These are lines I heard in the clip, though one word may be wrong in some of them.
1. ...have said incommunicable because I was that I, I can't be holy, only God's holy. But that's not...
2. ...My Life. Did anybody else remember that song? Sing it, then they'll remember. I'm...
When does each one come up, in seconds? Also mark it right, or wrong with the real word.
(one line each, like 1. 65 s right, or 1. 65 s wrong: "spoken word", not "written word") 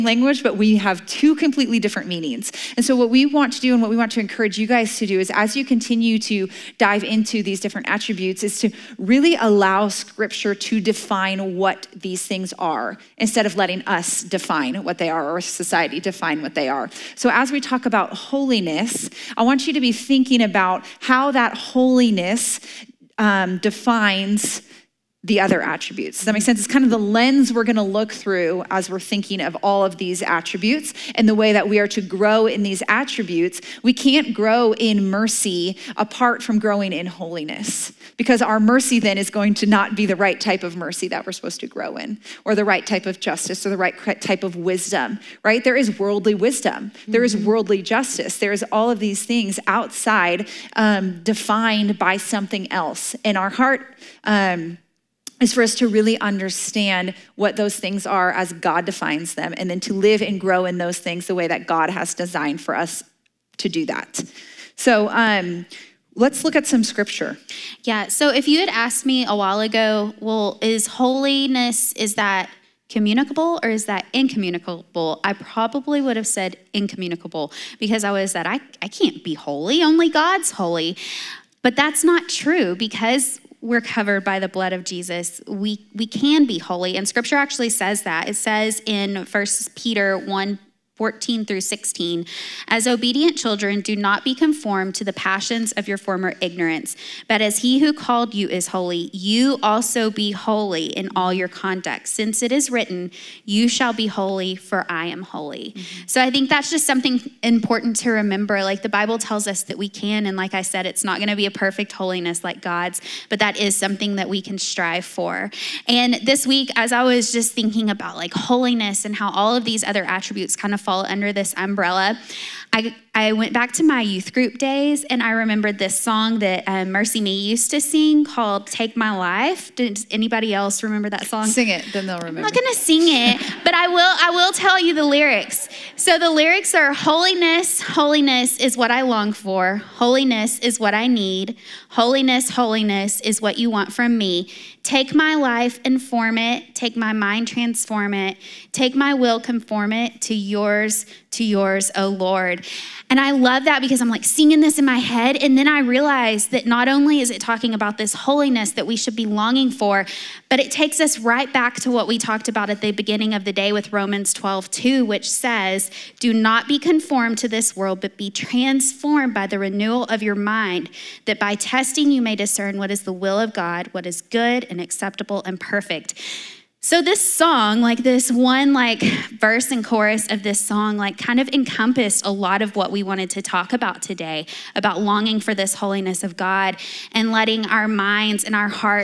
1. 76 s right
2. 128 s right.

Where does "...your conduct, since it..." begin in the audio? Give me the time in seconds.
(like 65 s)
101 s.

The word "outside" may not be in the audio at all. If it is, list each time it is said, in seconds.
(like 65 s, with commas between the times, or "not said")
49 s.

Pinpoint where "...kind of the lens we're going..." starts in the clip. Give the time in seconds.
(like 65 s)
26 s.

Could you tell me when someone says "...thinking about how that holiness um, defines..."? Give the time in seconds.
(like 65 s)
19 s.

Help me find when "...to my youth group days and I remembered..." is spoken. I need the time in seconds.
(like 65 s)
123 s.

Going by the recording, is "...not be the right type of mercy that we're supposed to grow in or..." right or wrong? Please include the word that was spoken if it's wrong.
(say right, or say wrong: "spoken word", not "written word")
right.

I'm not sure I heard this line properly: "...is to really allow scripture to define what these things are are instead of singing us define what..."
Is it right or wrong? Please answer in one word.
wrong.